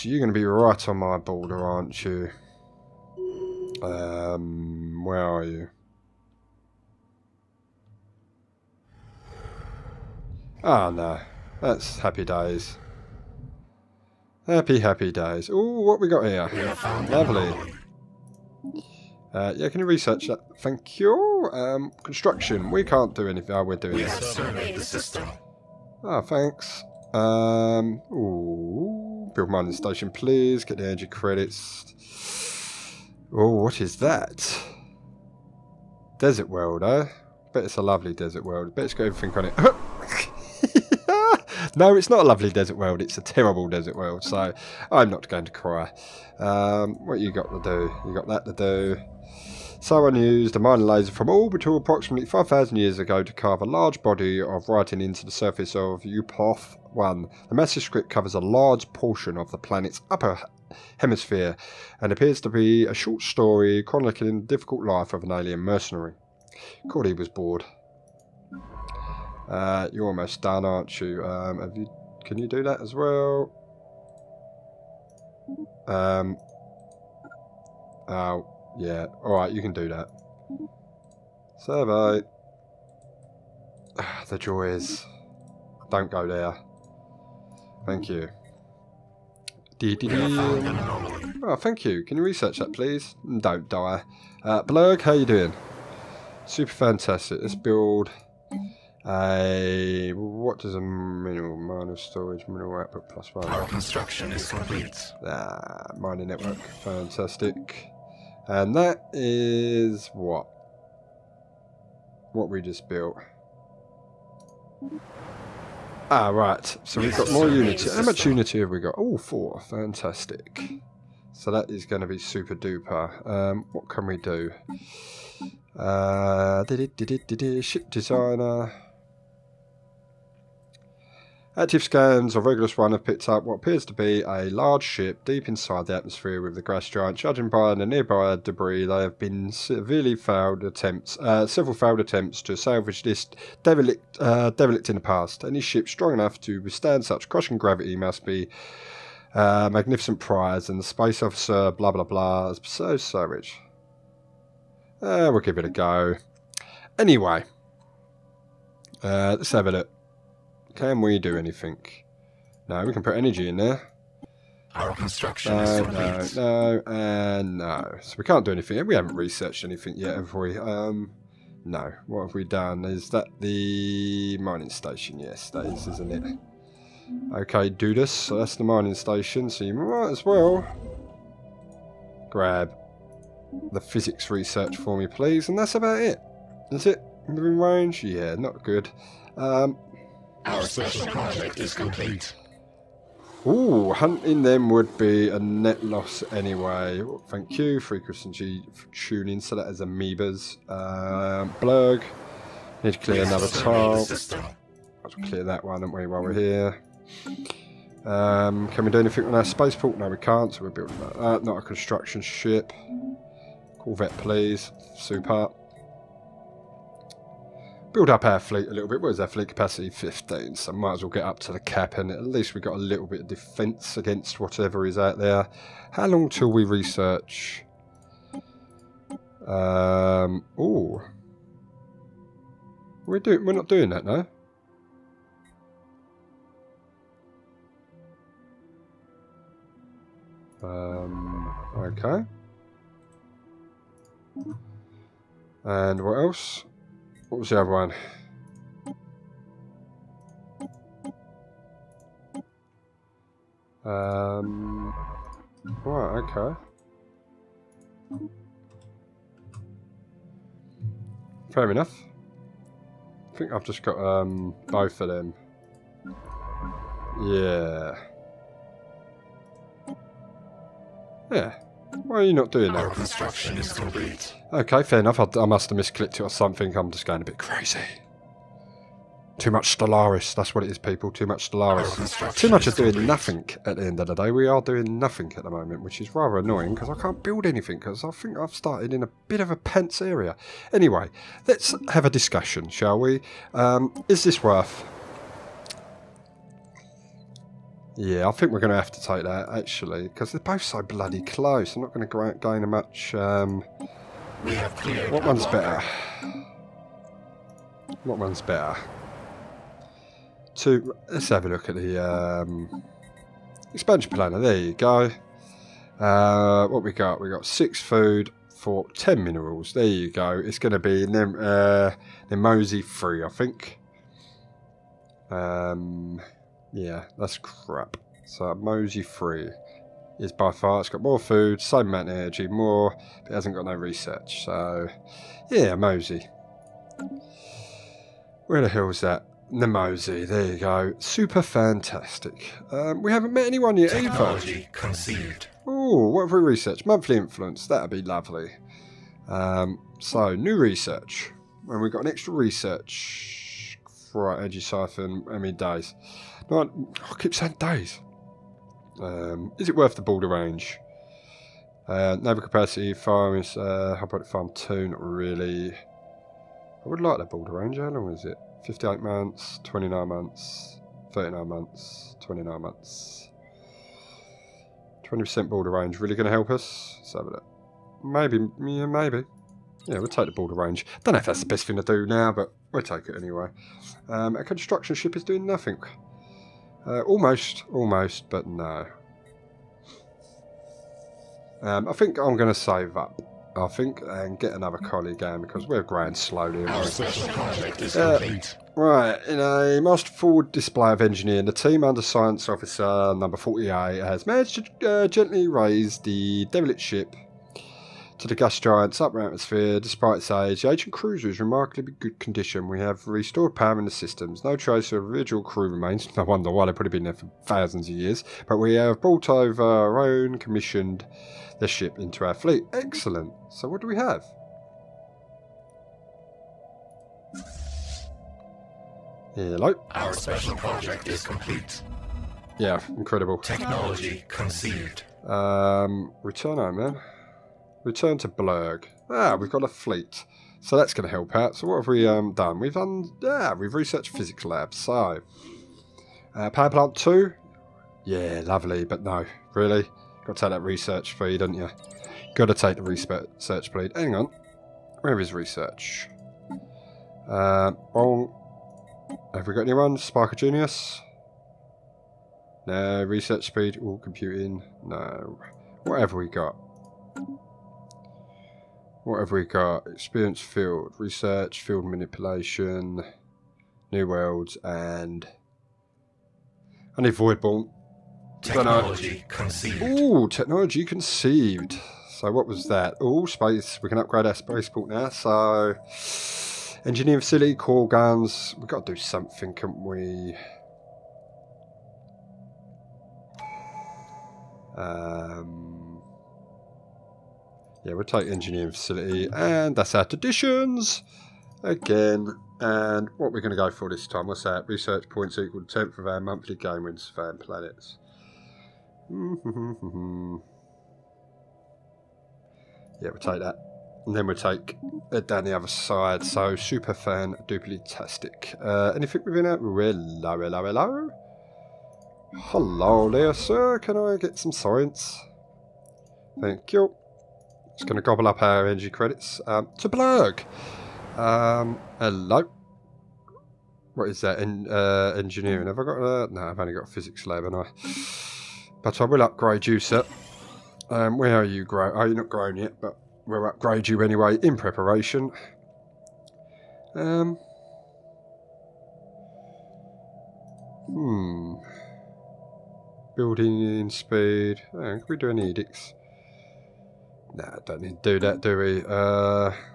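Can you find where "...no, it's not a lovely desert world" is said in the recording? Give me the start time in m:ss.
0:41.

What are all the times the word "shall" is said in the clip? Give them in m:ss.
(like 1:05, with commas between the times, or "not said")
4:52.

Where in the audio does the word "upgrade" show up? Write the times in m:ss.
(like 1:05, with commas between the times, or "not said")
8:03, 8:59, 9:03.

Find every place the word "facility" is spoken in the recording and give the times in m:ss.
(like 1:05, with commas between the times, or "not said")
8:07, 8:18.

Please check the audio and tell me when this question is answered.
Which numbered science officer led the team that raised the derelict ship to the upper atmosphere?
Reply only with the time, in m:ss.
6:42.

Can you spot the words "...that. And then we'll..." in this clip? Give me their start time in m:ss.
8:33.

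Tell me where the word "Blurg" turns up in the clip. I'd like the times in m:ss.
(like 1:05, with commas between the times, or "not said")
1:34, 3:21, 7:18, 8:49.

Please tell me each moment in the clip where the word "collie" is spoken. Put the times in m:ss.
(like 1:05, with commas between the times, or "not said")
6:34.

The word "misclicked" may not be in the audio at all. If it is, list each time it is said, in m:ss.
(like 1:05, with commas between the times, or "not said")
4:35.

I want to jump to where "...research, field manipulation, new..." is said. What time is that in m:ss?
7:50.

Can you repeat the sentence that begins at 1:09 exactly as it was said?
Uh, you're almost done, aren't you?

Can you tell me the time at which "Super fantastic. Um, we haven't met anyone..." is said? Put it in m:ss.
5:40.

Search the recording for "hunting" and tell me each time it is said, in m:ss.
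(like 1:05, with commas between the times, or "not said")
3:13.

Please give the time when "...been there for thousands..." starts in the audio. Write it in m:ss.
6:56.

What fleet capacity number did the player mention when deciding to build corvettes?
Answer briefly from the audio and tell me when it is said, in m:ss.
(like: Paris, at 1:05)
15, at 3:39.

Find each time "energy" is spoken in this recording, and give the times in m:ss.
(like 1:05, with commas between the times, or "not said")
0:30, 2:43, 5:32, 8:48.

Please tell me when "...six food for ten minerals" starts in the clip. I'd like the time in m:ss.
5:17.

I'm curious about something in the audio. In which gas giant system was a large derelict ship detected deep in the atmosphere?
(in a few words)
Regulus 1.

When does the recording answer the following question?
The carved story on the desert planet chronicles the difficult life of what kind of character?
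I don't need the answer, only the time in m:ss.
1:05.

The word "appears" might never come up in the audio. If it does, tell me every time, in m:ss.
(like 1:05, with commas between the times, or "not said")
1:02, 2:13.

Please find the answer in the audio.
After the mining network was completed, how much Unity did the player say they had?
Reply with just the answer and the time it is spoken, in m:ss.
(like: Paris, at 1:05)
4, at 1:59.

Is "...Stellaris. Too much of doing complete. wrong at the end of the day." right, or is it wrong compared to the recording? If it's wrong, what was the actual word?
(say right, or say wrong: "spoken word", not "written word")
wrong: "nothing", not "wrong".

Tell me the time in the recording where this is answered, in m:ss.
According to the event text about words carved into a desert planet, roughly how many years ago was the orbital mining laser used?
0:52.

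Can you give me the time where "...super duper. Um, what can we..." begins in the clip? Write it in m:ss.
2:02.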